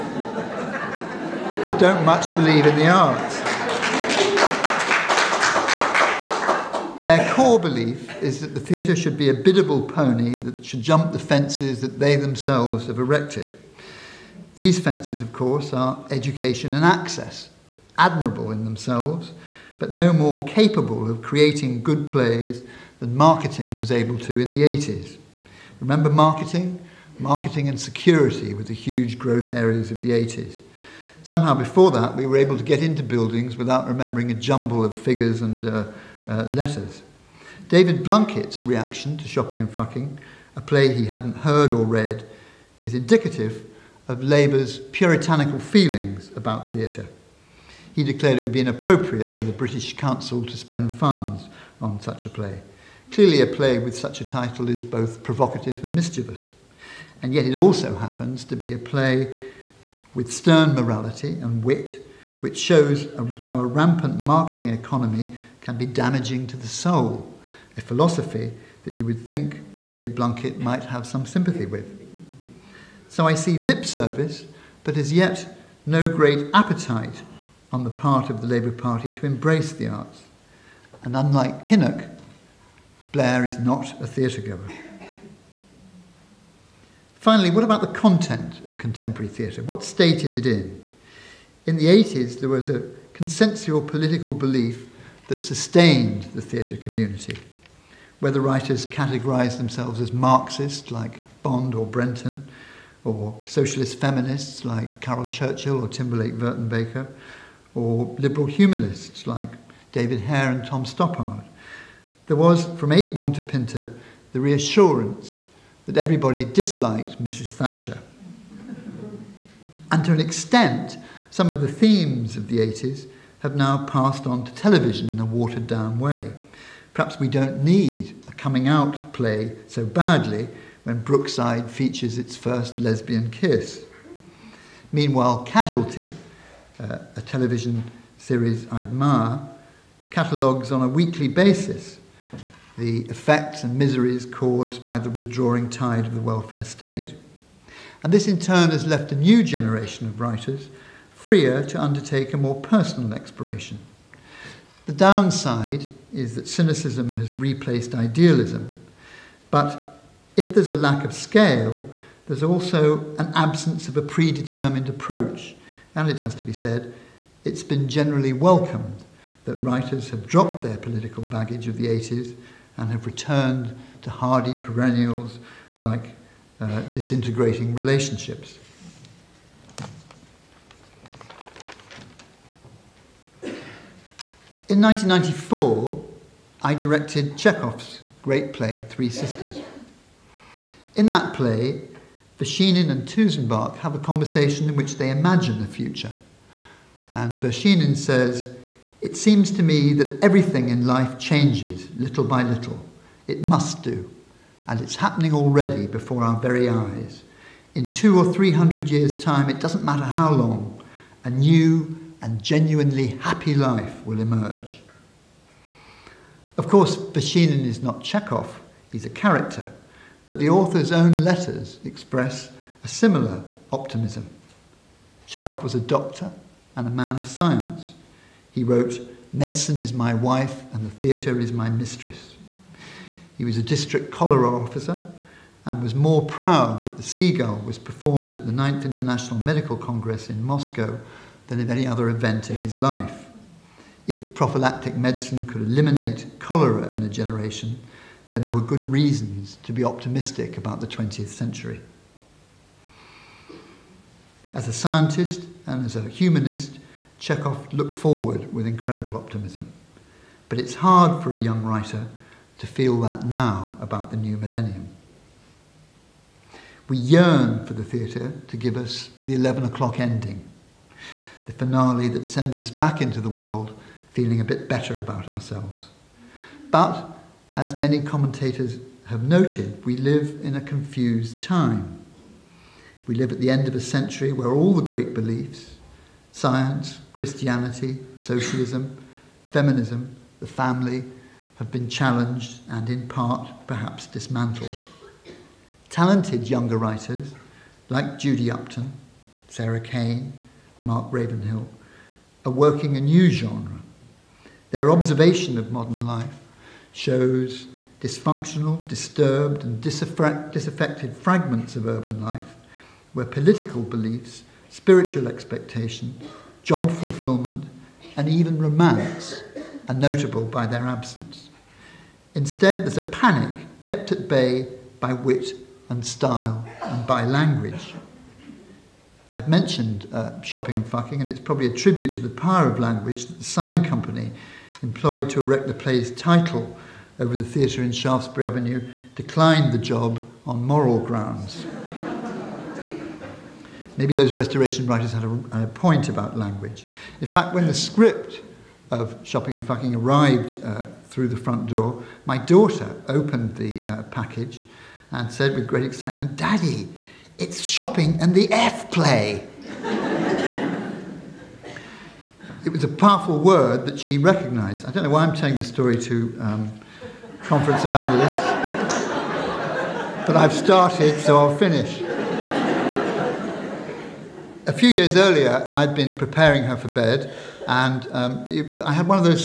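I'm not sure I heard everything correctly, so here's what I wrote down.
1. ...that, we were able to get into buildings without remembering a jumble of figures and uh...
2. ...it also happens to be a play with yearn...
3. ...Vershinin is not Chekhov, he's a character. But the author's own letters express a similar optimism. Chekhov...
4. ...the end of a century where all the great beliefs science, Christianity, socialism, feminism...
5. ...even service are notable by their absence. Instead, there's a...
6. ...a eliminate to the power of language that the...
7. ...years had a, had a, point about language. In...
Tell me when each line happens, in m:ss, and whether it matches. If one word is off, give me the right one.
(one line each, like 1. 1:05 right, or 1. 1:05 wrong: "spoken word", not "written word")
1. 0:31 right
2. 0:57 wrong: "stern", not "yearn"
3. 3:36 right
4. 4:43 right
5. 5:18 wrong: "romance", not "service"
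6. 5:31 wrong: "tribute", not "eliminate"
7. 5:44 wrong: "writers", not "years".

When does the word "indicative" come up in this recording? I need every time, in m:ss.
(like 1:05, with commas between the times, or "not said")
0:42.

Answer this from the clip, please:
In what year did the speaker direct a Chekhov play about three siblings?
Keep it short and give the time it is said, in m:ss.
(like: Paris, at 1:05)
1994, at 3:04.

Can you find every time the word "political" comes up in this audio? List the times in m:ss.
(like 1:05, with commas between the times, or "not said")
1:33, 2:50, 5:13.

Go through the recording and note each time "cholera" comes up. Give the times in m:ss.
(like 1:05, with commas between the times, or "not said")
3:54, 4:06.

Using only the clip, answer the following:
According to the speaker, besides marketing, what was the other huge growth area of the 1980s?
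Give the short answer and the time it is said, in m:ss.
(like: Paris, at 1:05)
Security, at 0:27.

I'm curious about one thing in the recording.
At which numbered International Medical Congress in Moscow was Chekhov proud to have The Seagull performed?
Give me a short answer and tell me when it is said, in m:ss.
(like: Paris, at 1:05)
9th, at 3:58.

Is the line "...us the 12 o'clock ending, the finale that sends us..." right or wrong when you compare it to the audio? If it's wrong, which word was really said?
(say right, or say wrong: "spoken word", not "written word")
wrong: "11", not "12".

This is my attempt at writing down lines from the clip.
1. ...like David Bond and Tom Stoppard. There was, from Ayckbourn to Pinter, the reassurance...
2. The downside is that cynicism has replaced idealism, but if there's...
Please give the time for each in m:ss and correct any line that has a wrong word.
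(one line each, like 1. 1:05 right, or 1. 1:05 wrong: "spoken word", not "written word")
1. 1:49 wrong: "Hare", not "Bond"
2. 2:34 right.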